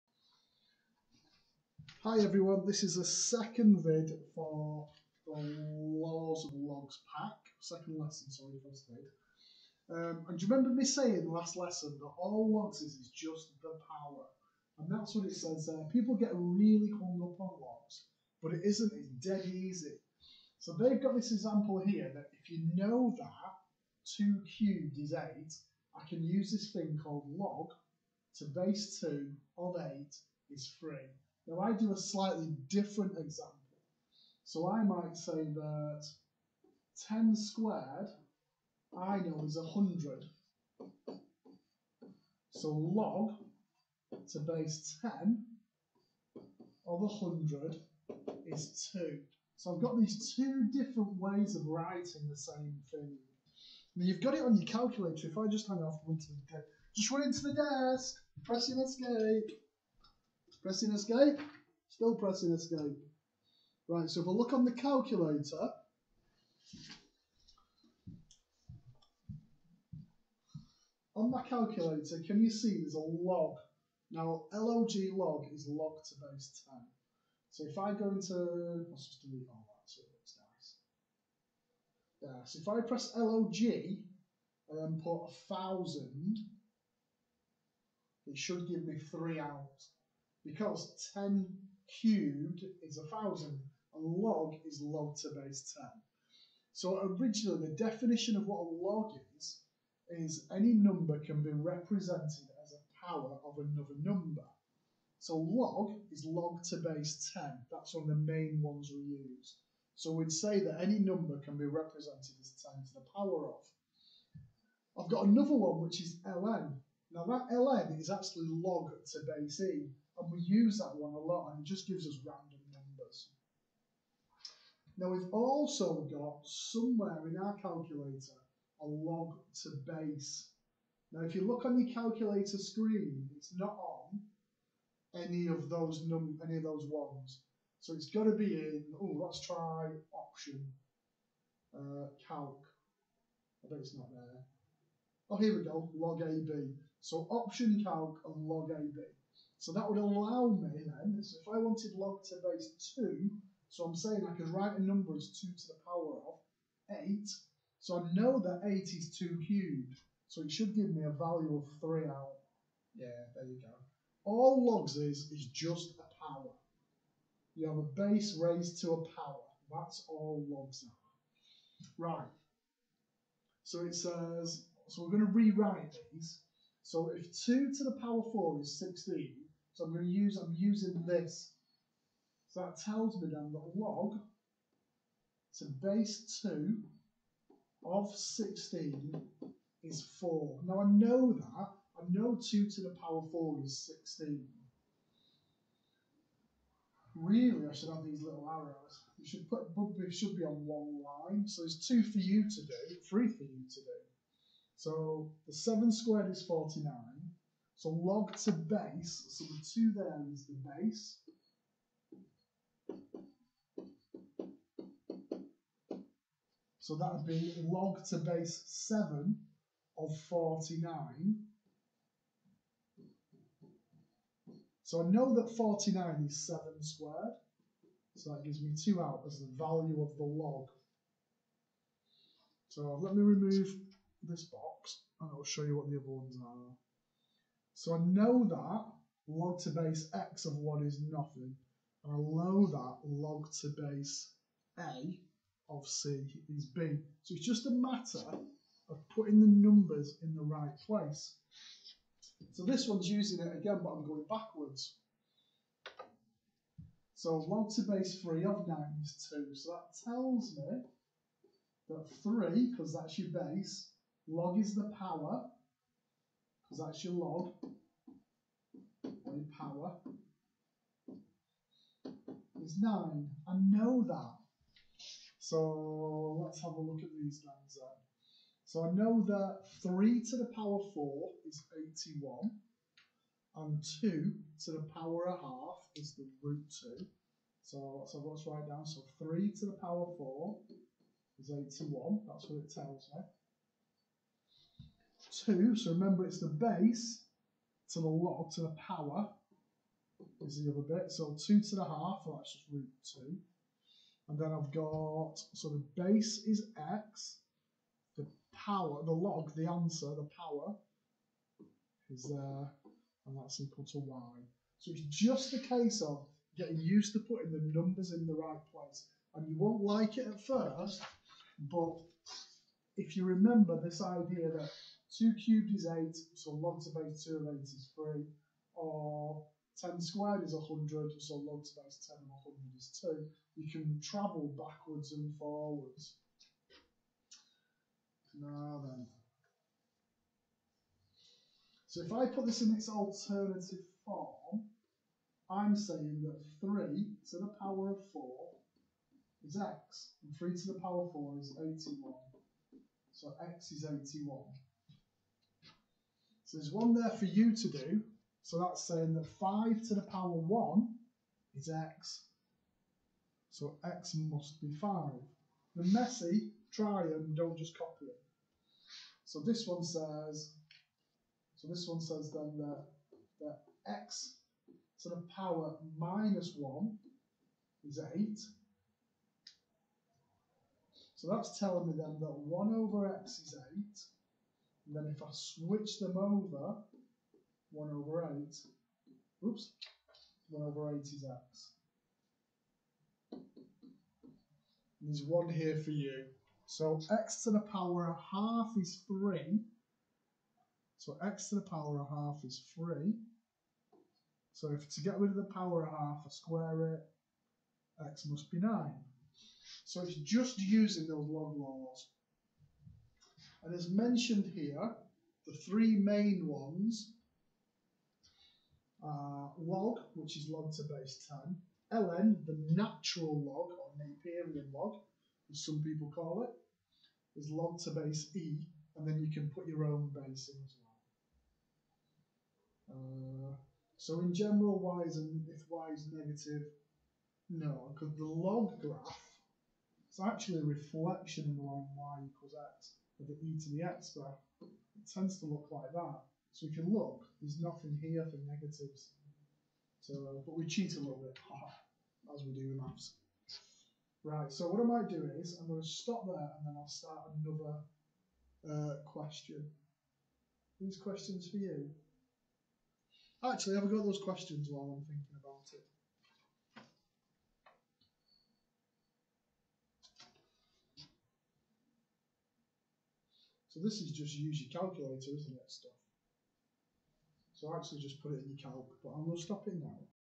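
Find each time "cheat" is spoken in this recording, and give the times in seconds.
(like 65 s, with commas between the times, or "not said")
450 s.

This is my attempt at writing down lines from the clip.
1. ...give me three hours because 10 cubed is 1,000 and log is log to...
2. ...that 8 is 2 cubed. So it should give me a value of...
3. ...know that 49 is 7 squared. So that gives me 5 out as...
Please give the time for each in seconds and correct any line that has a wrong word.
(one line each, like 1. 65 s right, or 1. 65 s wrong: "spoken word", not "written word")
1. 88 s right
2. 158 s right
3. 225 s wrong: "2", not "5".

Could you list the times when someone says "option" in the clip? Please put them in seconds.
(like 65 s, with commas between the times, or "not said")
140 s, 147 s.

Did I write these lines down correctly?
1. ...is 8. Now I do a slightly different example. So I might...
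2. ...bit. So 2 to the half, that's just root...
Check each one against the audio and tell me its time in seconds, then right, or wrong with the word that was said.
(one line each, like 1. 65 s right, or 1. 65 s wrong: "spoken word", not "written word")
1. 30 s wrong: "3", not "8"
2. 301 s right.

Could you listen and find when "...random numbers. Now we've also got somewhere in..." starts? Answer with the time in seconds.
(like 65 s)
122 s.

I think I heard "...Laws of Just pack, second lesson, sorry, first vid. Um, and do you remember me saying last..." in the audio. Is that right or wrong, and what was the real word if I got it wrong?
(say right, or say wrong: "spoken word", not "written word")
wrong: "Logs", not "Just".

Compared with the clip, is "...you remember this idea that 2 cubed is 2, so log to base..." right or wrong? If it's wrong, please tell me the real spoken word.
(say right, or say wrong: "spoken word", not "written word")
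wrong: "8", not "2".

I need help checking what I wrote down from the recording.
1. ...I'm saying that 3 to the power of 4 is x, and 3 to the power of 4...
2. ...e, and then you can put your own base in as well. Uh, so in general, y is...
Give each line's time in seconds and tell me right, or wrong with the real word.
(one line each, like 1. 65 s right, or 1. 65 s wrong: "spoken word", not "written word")
1. 345 s right
2. 428 s right.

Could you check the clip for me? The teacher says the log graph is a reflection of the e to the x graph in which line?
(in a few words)
y equals x.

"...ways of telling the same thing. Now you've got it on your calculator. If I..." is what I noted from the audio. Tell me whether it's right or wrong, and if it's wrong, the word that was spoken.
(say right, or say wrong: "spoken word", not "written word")
wrong: "writing", not "telling".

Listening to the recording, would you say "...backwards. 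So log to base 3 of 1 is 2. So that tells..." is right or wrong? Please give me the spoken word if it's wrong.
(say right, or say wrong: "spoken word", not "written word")
wrong: "9", not "1".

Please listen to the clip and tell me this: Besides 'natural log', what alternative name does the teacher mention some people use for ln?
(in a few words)
Napierian log.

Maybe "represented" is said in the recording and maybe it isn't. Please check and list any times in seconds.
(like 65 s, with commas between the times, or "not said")
101 s, 111 s.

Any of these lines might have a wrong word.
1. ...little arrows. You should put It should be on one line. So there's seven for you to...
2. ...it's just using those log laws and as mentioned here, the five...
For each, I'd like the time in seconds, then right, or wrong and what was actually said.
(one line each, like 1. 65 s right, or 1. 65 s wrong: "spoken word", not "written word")
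1. 198 s wrong: "two", not "seven"
2. 410 s wrong: "three", not "five".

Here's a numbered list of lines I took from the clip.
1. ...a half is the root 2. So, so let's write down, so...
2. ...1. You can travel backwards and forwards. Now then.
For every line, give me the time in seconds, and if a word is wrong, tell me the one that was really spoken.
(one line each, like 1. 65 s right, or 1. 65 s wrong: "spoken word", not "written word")
1. 285 s right
2. 333 s wrong: "2", not "1".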